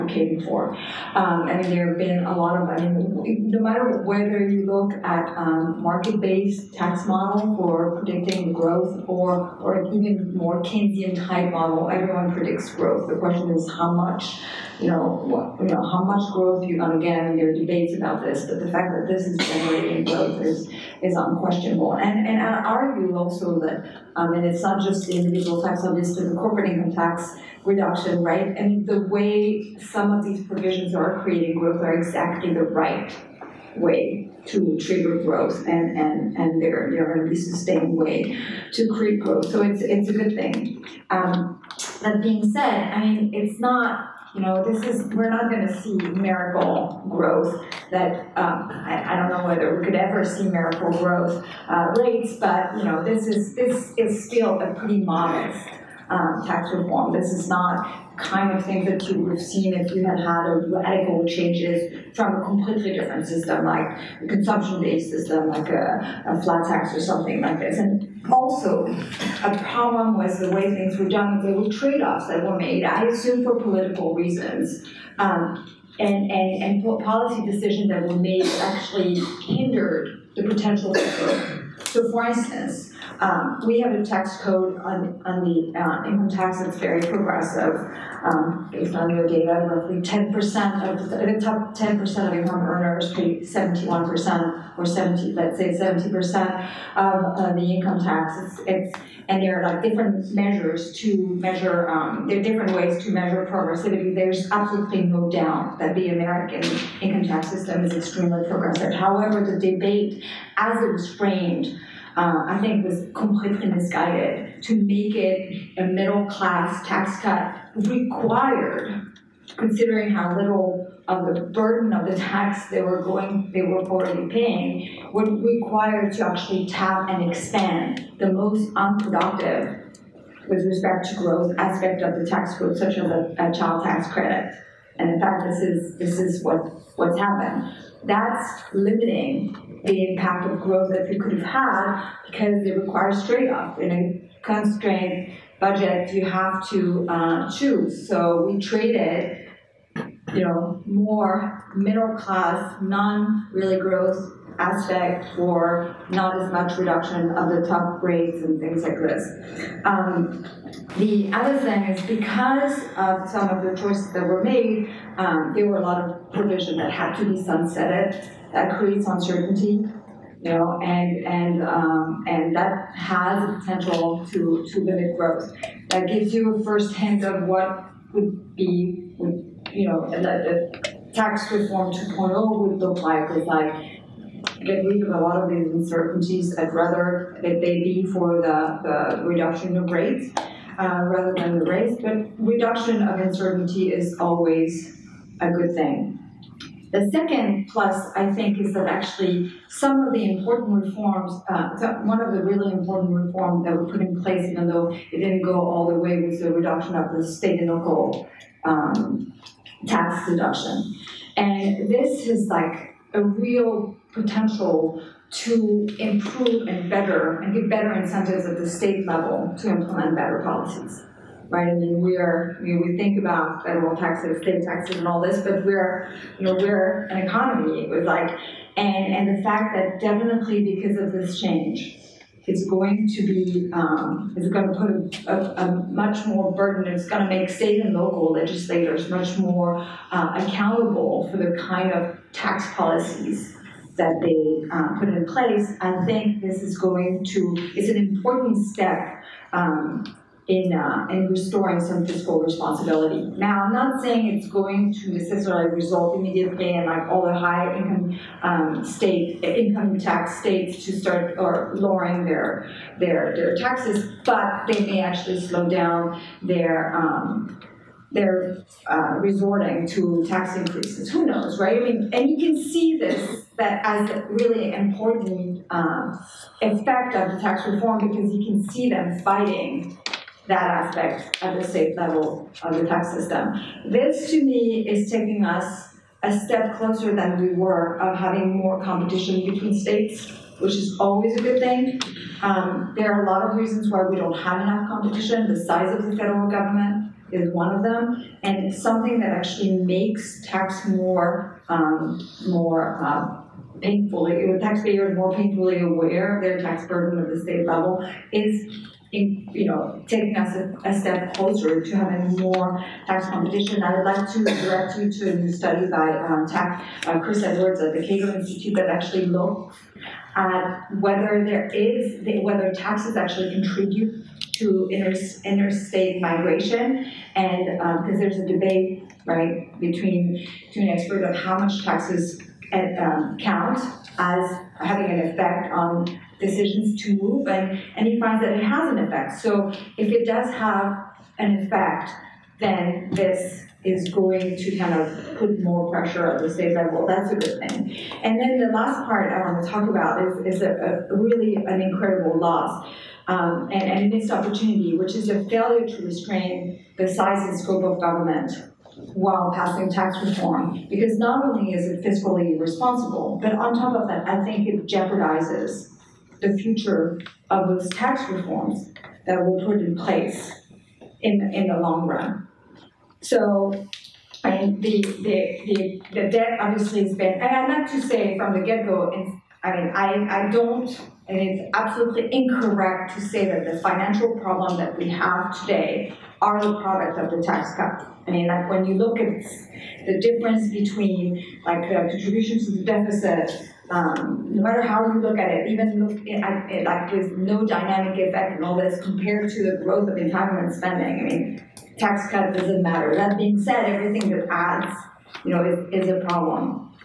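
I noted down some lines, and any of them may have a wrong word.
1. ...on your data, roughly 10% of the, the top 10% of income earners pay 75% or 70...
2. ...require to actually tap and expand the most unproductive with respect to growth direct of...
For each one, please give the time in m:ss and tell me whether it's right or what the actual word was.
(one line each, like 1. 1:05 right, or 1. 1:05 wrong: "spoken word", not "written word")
1. 1:28 wrong: "71", not "75"
2. 2:05 wrong: "aspect", not "direct".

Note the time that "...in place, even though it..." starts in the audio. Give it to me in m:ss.
3:23.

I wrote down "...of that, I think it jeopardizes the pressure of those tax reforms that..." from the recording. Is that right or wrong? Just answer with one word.
wrong.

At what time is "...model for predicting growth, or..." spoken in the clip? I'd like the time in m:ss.
0:07.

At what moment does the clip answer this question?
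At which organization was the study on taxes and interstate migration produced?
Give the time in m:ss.
5:18.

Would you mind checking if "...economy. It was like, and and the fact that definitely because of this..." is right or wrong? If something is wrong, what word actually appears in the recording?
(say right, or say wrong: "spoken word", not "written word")
right.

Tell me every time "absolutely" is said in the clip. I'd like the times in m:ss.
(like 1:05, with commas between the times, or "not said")
1:44, 6:21.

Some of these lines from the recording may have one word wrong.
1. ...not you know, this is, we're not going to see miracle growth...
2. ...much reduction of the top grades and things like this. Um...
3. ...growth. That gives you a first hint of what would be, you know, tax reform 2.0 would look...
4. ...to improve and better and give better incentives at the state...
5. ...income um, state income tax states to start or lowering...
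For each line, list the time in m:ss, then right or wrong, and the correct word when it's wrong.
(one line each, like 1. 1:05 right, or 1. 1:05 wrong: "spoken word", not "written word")
1. 0:43 right
2. 2:36 right
3. 2:55 right
4. 3:35 right
5. 4:17 right.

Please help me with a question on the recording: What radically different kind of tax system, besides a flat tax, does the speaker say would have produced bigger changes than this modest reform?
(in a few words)
consumption-based system.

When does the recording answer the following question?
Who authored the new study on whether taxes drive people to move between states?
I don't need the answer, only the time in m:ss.
5:17.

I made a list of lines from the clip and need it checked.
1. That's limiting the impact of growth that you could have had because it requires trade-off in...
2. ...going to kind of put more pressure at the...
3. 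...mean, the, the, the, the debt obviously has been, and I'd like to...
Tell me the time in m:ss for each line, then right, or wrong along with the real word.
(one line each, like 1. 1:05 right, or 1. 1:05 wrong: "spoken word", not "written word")
1. 2:18 right
2. 5:44 right
3. 6:14 right.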